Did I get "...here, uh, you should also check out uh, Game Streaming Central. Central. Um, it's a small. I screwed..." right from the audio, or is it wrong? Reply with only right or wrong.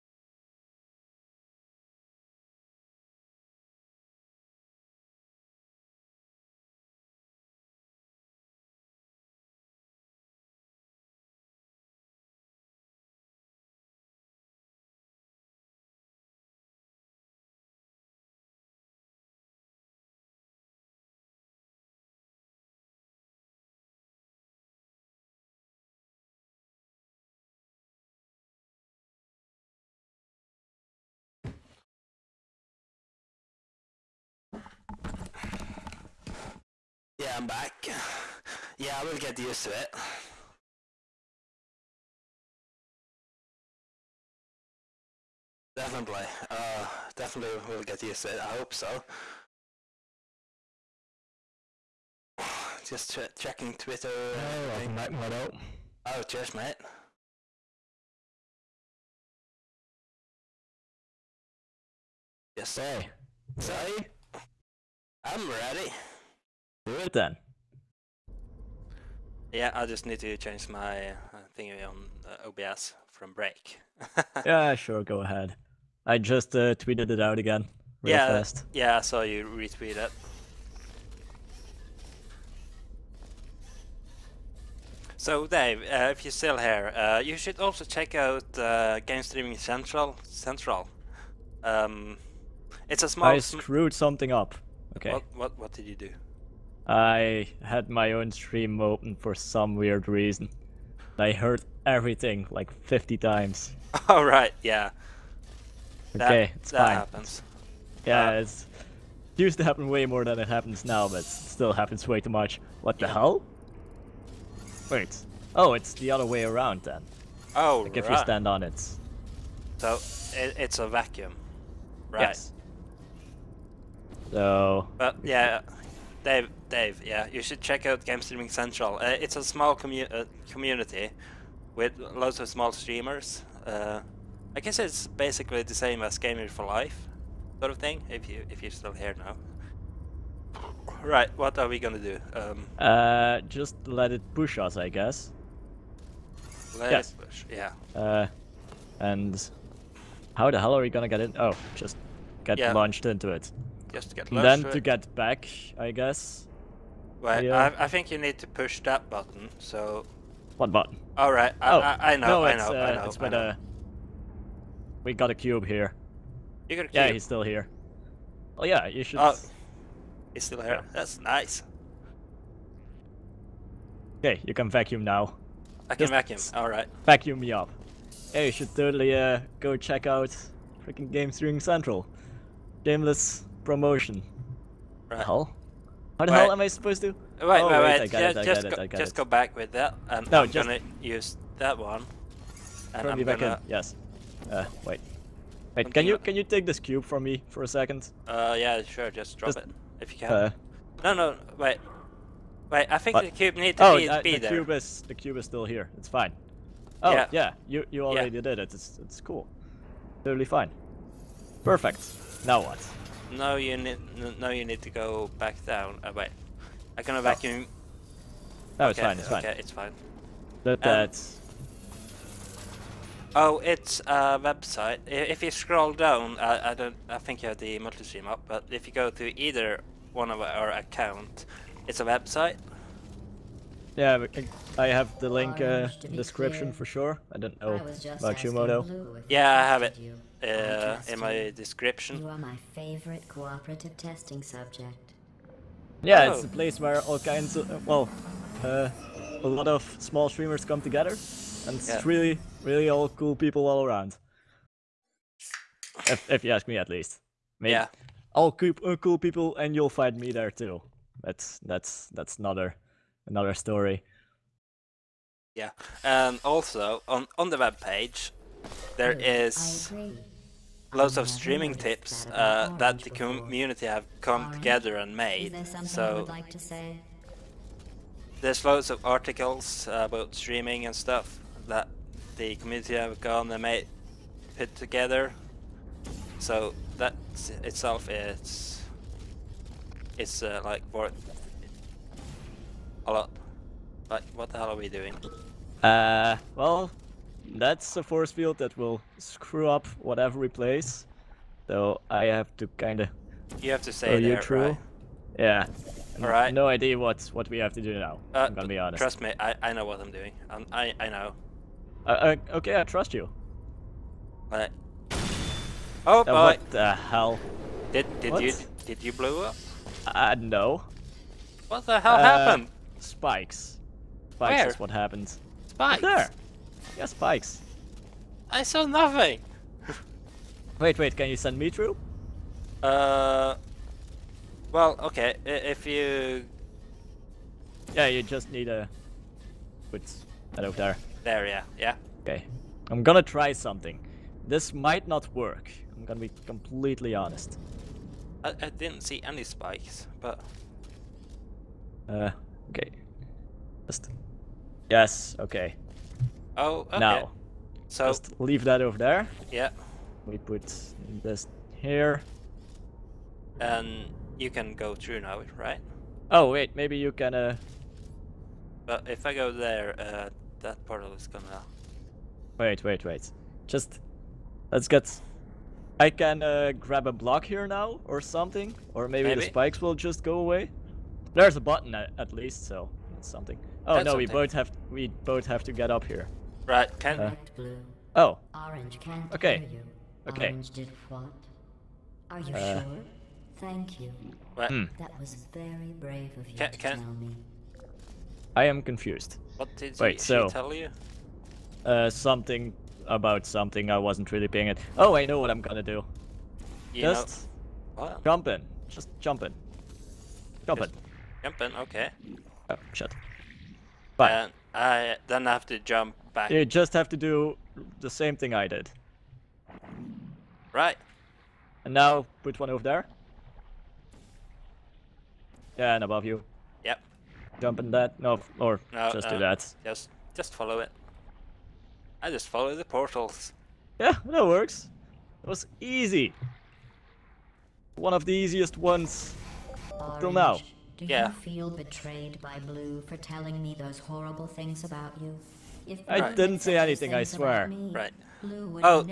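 right.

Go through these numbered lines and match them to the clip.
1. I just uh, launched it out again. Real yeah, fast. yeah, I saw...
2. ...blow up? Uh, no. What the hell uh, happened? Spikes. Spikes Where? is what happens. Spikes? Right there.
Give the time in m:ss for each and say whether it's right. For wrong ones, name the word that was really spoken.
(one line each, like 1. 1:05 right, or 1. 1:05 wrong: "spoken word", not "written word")
1. 1:16 wrong: "tweeted", not "launched"
2. 5:19 right.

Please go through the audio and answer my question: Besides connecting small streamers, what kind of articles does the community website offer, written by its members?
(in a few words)
Streaming tips.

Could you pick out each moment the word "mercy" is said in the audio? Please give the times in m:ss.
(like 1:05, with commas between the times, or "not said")
not said.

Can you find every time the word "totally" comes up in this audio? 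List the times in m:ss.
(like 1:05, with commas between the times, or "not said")
2:58, 3:30.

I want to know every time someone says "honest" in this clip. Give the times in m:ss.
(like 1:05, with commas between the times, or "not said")
5:08, 5:47.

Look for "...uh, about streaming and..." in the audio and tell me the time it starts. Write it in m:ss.
4:39.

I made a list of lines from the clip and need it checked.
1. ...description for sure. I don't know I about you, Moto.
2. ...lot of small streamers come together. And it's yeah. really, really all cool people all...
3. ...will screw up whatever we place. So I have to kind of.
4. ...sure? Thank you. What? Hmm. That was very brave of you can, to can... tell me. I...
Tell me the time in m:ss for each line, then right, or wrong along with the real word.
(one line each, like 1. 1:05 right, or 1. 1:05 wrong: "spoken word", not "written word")
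1. 3:56 right
2. 4:09 right
3. 4:58 right
4. 6:32 right.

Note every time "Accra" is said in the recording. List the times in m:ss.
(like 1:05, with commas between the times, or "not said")
not said.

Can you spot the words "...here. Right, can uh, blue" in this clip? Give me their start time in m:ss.
6:26.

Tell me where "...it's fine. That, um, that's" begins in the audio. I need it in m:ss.
3:39.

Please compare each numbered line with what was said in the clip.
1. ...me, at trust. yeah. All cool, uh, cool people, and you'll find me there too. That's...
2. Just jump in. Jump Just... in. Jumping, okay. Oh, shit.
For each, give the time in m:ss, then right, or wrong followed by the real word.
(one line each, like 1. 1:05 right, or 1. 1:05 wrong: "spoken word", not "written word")
1. 4:16 wrong: "least", not "trust"
2. 6:48 right.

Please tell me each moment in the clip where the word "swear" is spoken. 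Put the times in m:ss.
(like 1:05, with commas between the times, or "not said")
7:27.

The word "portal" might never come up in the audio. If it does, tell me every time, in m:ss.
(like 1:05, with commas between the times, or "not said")
6:10, 7:12.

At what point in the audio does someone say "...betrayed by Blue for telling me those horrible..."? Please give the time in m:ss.
7:21.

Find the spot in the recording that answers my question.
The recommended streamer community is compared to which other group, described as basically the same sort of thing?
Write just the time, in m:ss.
2:16.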